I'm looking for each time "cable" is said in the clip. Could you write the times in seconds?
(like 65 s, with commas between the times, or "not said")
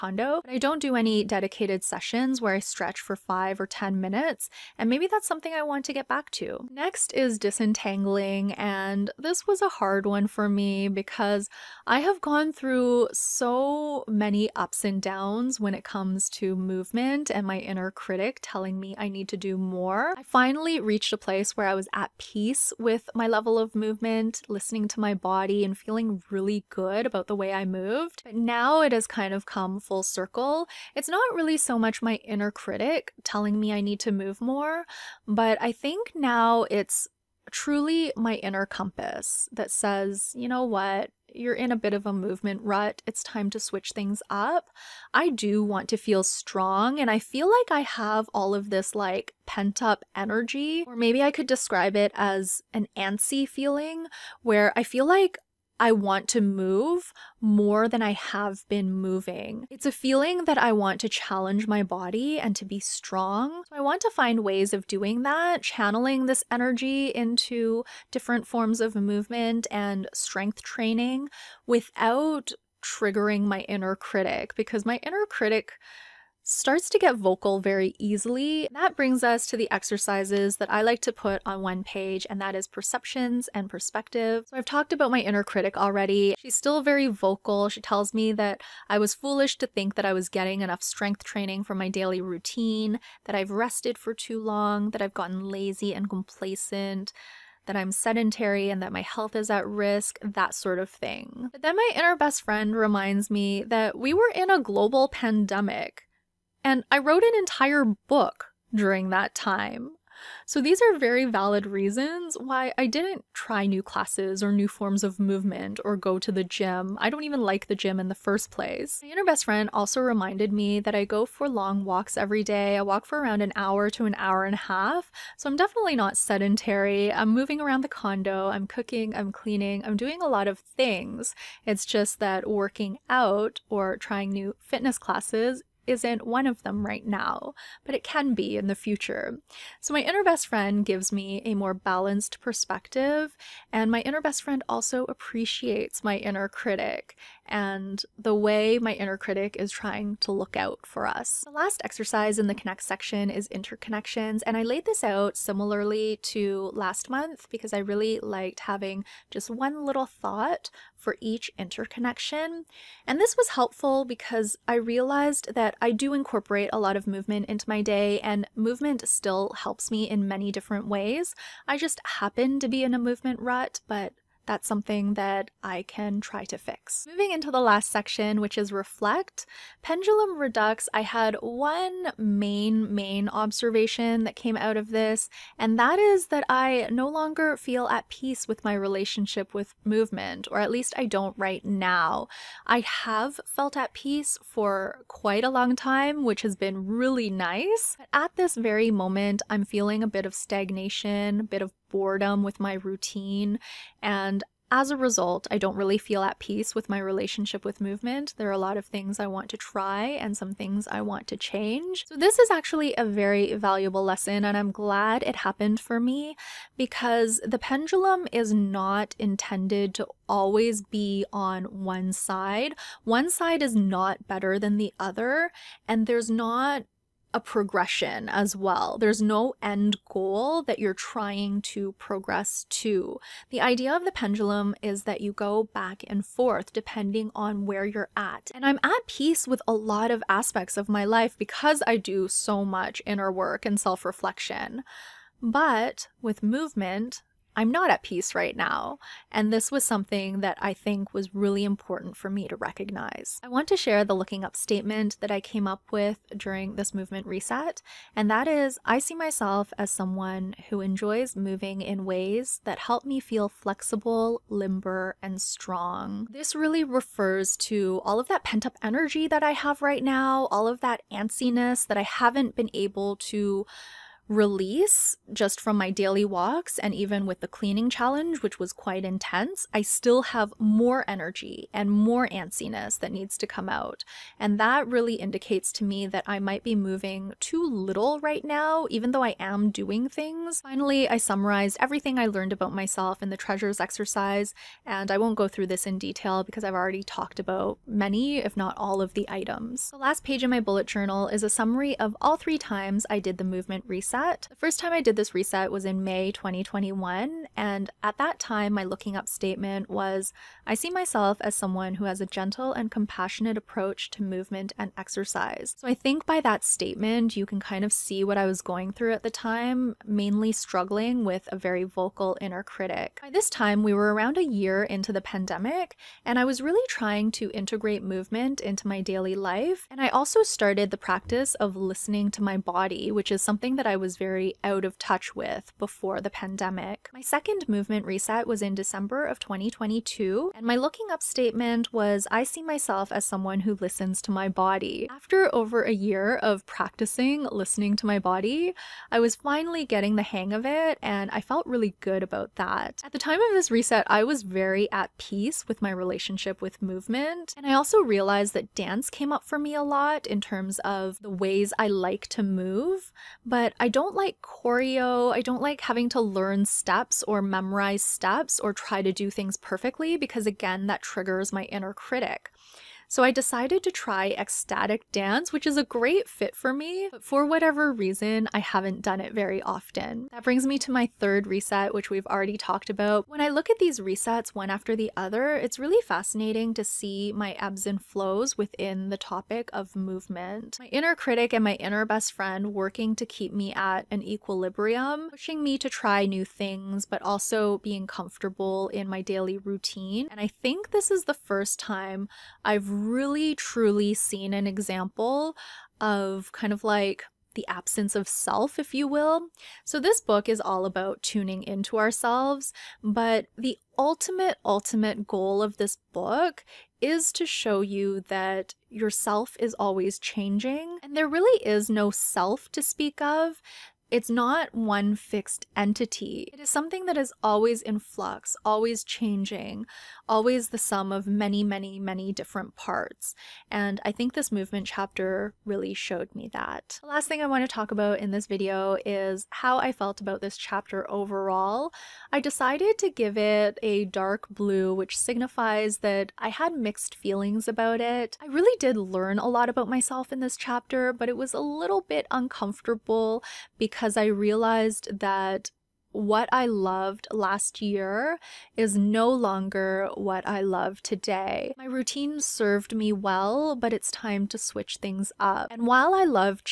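not said.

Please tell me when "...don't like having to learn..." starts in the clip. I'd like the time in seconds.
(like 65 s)
365 s.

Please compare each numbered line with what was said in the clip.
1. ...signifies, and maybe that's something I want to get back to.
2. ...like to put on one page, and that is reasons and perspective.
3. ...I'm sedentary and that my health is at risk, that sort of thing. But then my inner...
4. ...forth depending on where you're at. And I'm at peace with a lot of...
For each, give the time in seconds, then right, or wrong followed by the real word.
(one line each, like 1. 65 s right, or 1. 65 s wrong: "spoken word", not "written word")
1. 4 s wrong: "minutes", not "signifies"
2. 80 s wrong: "perceptions", not "reasons"
3. 97 s right
4. 236 s right.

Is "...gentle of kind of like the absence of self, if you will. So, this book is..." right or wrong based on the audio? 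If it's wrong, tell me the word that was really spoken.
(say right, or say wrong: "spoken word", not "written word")
wrong: "example", not "gentle".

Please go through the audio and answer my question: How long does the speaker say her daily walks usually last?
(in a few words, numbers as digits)
1 to 1.5 hours.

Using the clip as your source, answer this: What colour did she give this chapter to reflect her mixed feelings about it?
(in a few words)
dark blue.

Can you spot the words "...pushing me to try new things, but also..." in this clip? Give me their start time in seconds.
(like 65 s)
395 s.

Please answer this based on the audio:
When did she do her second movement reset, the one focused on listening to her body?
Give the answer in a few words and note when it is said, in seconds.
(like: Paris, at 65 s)
December 2022, at 338 s.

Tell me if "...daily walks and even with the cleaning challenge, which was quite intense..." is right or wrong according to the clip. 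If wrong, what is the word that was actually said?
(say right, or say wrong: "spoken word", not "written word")
right.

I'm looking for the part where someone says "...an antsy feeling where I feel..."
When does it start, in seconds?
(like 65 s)
52 s.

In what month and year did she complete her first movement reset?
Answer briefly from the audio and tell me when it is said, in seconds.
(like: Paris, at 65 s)
May 2021, at 306 s.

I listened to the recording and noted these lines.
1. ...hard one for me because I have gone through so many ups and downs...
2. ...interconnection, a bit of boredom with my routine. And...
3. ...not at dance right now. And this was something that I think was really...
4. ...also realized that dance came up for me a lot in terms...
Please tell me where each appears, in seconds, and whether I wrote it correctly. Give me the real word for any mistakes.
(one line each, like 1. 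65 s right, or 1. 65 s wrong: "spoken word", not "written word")
1. 9 s right
2. 200 s wrong: "stagnation", not "interconnection"
3. 247 s wrong: "peace", not "dance"
4. 357 s right.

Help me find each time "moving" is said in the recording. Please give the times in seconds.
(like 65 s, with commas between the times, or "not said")
58 s, 127 s, 177 s, 261 s, 286 s.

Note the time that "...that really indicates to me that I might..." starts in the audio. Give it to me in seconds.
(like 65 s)
284 s.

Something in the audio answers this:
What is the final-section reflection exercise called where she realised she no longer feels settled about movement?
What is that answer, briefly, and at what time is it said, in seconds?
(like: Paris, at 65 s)
pendulum redux, at 179 s.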